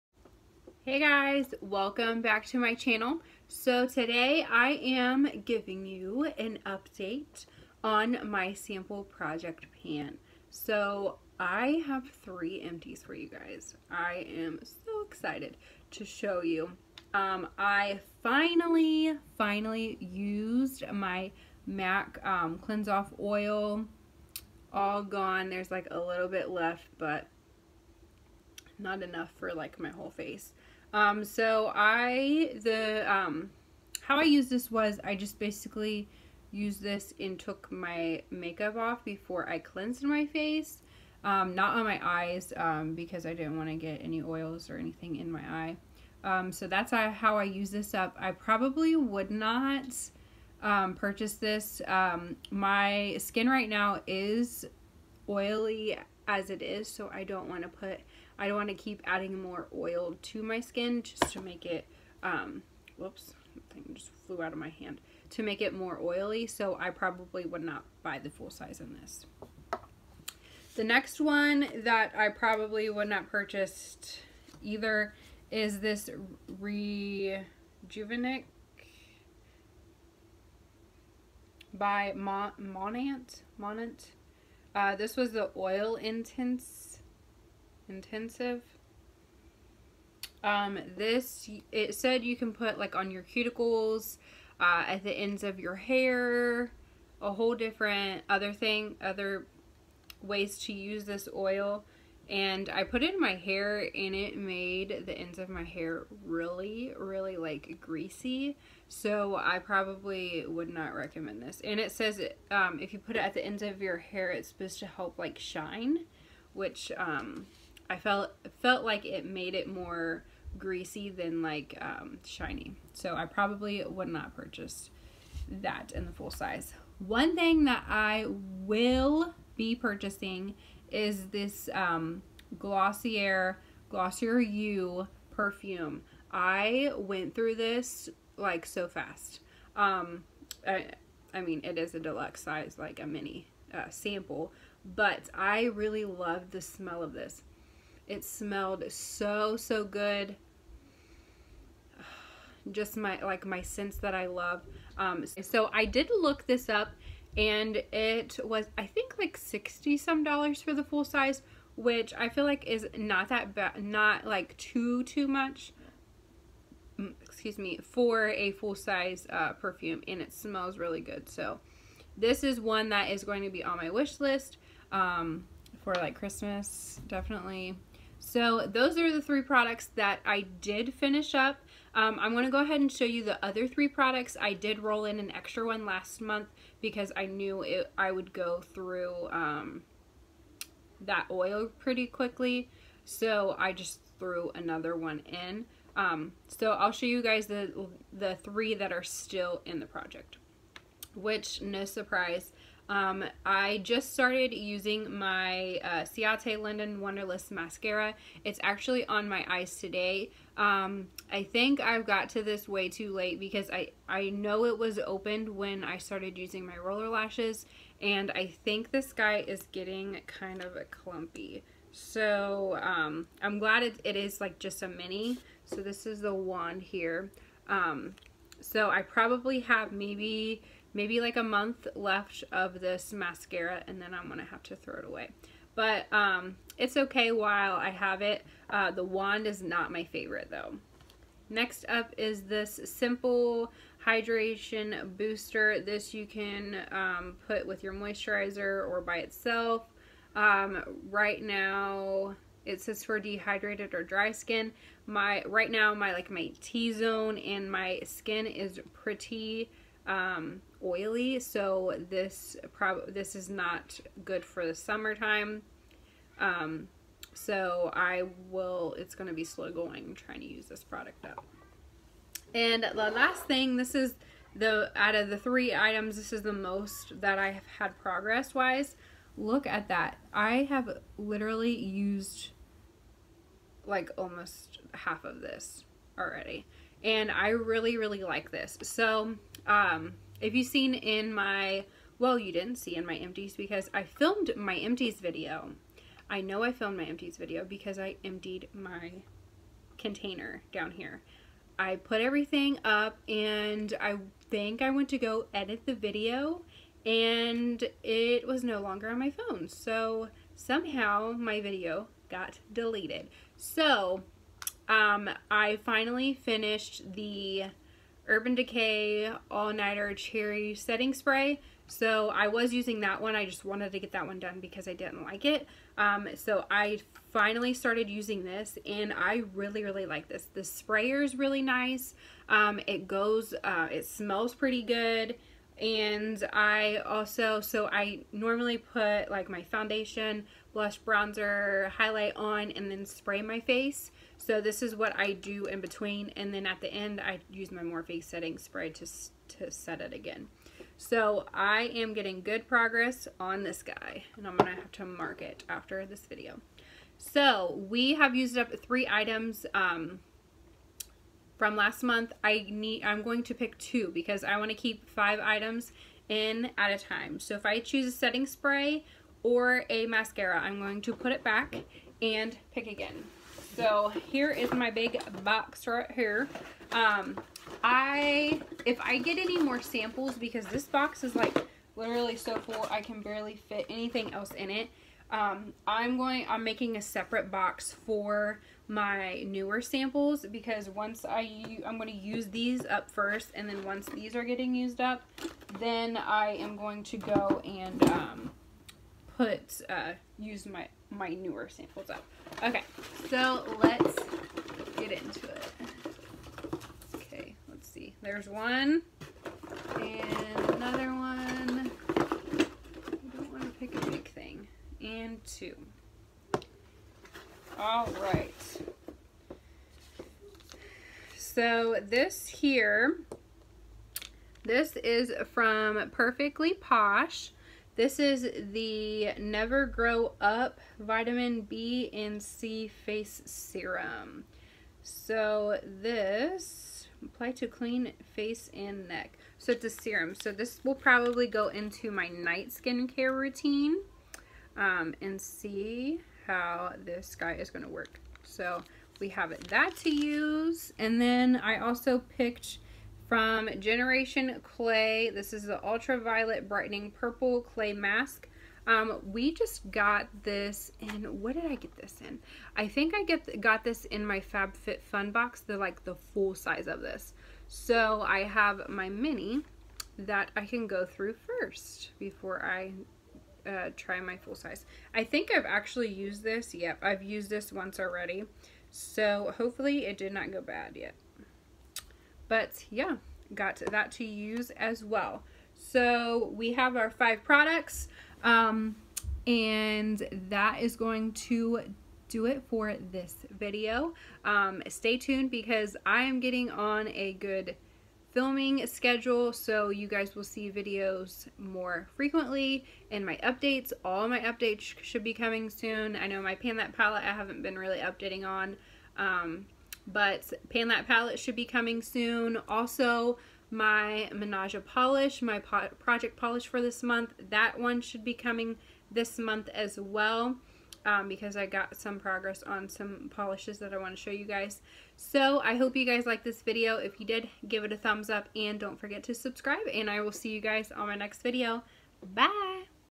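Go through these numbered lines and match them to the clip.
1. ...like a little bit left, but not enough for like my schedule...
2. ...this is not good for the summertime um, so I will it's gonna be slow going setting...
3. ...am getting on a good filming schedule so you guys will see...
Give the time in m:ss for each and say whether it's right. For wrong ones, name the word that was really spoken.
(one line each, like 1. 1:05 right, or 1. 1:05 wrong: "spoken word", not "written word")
1. 0:25 wrong: "whole", not "schedule"
2. 4:23 wrong: "trying", not "setting"
3. 8:16 right.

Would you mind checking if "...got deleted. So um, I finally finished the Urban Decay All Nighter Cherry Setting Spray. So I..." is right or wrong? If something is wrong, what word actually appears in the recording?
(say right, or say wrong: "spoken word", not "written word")
right.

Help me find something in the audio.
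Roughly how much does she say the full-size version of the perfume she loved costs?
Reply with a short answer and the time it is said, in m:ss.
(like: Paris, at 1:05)
60 some dollars, at 2:39.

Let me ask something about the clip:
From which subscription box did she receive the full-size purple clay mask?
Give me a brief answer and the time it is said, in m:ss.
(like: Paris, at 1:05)
FabFitFun, at 7:44.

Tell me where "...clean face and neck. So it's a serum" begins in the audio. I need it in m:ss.
7:17.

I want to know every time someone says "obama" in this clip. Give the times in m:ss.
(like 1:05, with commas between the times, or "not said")
not said.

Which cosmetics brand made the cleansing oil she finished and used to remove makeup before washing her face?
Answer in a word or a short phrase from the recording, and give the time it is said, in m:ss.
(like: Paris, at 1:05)
MAC, at 0:21.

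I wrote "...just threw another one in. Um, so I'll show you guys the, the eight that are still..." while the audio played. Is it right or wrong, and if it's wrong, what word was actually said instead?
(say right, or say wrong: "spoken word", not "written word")
wrong: "three", not "eight".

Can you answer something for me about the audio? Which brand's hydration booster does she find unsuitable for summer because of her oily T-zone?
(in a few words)
Simple.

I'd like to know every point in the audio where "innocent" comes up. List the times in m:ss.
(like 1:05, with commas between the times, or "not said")
not said.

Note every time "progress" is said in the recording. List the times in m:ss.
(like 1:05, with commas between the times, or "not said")
4:37, 5:52, 8:42.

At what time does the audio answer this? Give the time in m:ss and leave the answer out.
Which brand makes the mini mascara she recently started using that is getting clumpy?
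3:26.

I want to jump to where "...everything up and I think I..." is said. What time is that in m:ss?
5:02.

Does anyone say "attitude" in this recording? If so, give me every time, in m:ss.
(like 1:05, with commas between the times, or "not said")
not said.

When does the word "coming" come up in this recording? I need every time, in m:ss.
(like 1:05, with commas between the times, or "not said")
8:25, 8:31, 8:38.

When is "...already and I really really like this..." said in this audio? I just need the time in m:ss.
4:46.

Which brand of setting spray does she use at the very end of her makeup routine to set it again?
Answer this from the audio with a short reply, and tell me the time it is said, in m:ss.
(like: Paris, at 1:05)
Morphe, at 5:47.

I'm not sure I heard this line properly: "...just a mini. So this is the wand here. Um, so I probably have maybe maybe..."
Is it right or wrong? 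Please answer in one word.
right.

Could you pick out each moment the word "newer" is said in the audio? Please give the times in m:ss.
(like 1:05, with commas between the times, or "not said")
6:29, 6:41.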